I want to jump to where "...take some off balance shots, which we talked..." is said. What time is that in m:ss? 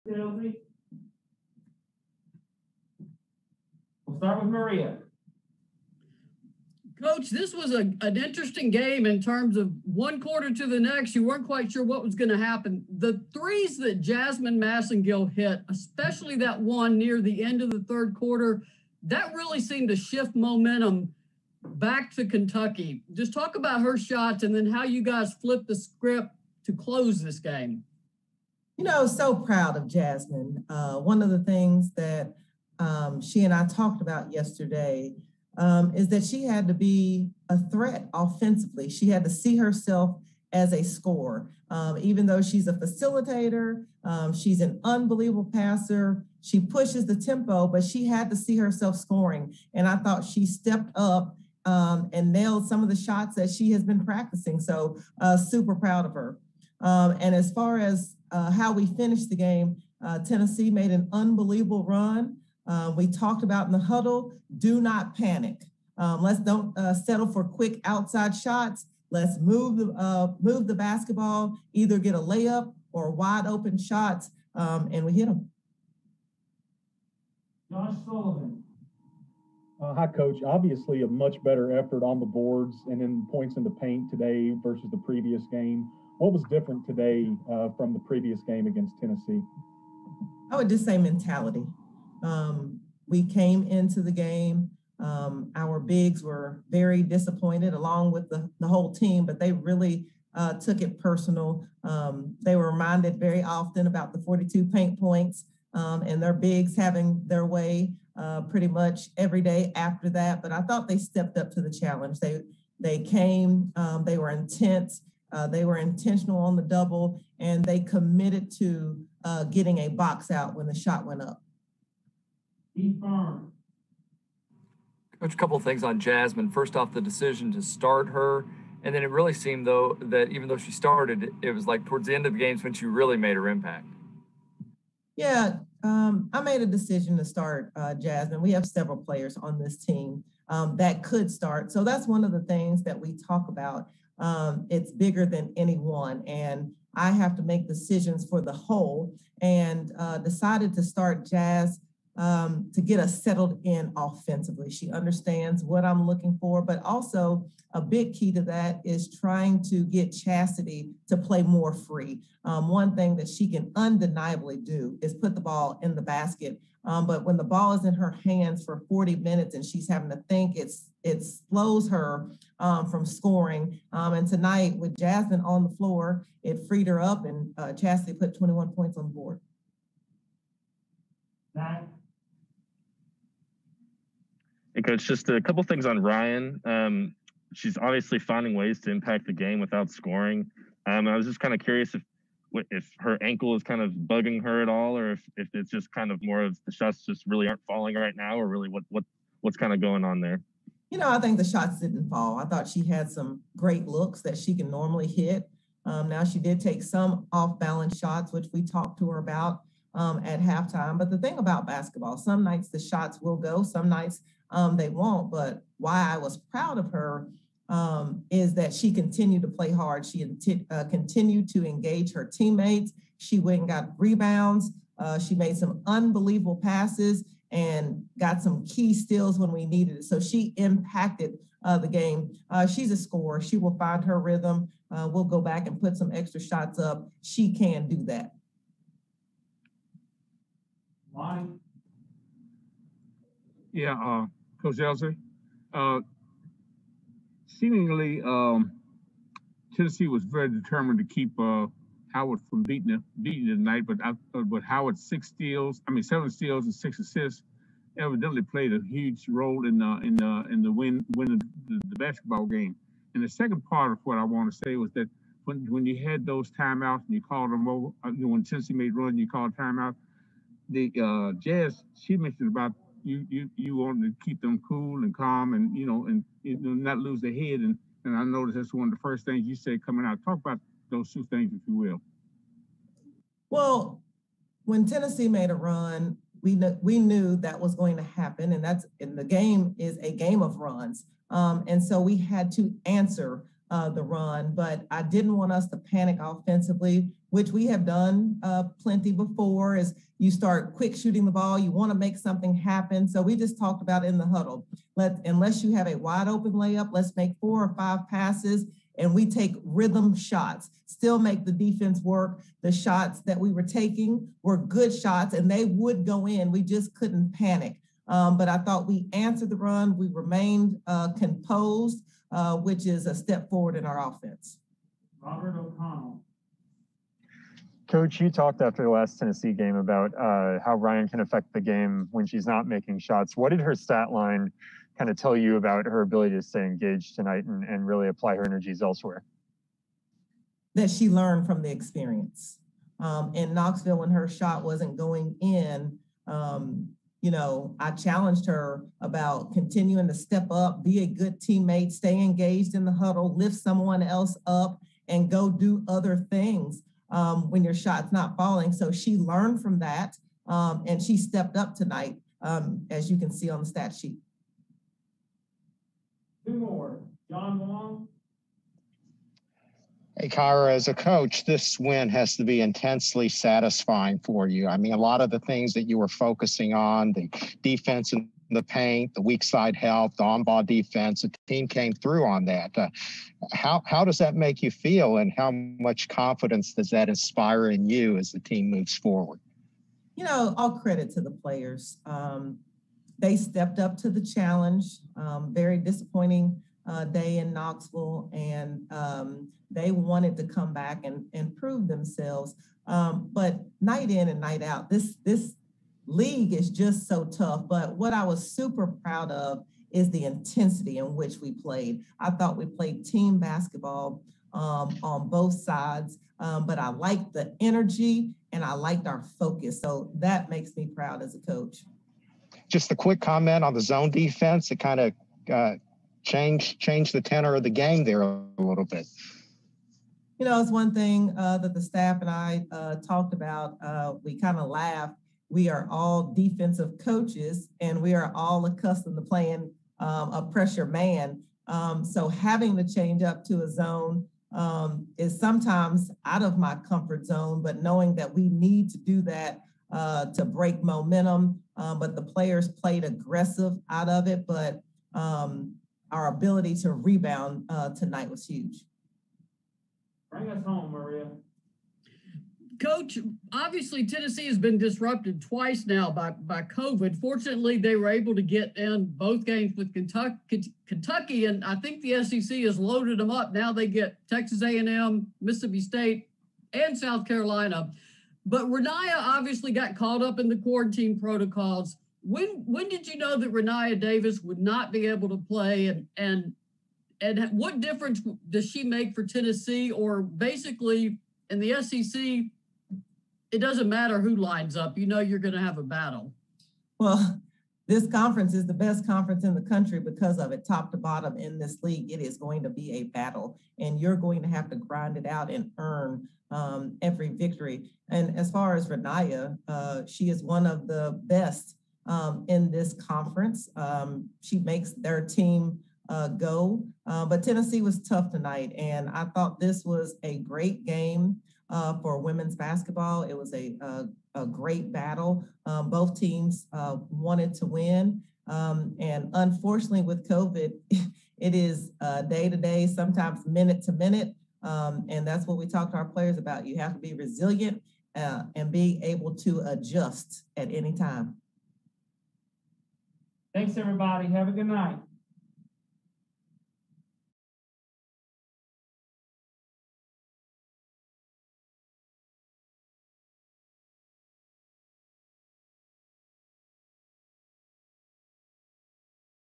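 3:26.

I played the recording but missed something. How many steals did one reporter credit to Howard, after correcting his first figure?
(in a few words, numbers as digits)
7.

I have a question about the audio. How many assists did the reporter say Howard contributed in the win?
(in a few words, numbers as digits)
6.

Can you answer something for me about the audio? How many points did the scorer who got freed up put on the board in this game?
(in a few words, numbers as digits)
21.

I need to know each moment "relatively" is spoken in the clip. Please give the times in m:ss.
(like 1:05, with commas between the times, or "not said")
not said.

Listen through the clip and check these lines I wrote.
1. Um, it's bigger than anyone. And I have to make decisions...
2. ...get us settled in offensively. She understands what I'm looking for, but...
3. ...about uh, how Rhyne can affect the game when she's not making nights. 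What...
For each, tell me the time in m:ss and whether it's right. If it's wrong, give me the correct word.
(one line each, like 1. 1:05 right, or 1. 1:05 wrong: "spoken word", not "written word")
1. 2:24 right
2. 2:32 right
3. 5:29 wrong: "shots", not "nights".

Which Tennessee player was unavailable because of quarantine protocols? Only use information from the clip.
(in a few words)
Rennia Davis.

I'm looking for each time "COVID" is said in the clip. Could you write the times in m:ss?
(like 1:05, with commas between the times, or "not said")
7:46, 8:50.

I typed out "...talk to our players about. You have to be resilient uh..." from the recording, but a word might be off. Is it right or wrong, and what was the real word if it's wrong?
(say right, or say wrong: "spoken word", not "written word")
right.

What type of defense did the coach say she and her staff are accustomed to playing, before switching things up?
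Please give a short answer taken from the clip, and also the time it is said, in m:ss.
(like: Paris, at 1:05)
Pressure man, at 7:20.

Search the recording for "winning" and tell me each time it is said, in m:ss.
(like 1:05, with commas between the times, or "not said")
4:21.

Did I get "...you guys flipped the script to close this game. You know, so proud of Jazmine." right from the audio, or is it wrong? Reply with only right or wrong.
right.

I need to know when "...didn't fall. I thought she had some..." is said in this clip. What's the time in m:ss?
3:21.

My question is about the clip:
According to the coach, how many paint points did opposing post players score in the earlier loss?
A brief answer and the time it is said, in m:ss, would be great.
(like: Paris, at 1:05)
42, at 1:44.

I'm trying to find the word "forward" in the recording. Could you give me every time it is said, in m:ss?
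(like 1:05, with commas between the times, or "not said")
5:23, 6:28.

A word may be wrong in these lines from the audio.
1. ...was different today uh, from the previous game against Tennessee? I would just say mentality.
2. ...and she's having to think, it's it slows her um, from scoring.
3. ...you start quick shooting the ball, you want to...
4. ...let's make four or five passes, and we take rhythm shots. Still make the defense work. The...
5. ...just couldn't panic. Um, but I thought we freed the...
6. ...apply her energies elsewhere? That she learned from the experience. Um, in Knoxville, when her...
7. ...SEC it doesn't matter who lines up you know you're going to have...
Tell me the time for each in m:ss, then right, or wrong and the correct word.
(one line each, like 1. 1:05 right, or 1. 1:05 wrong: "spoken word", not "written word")
1. 1:26 right
2. 2:49 right
3. 5:00 right
4. 5:06 right
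5. 5:16 wrong: "answered", not "freed"
6. 5:38 right
7. 8:11 right.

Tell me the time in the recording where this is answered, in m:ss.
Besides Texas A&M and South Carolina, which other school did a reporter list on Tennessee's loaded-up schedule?
7:55.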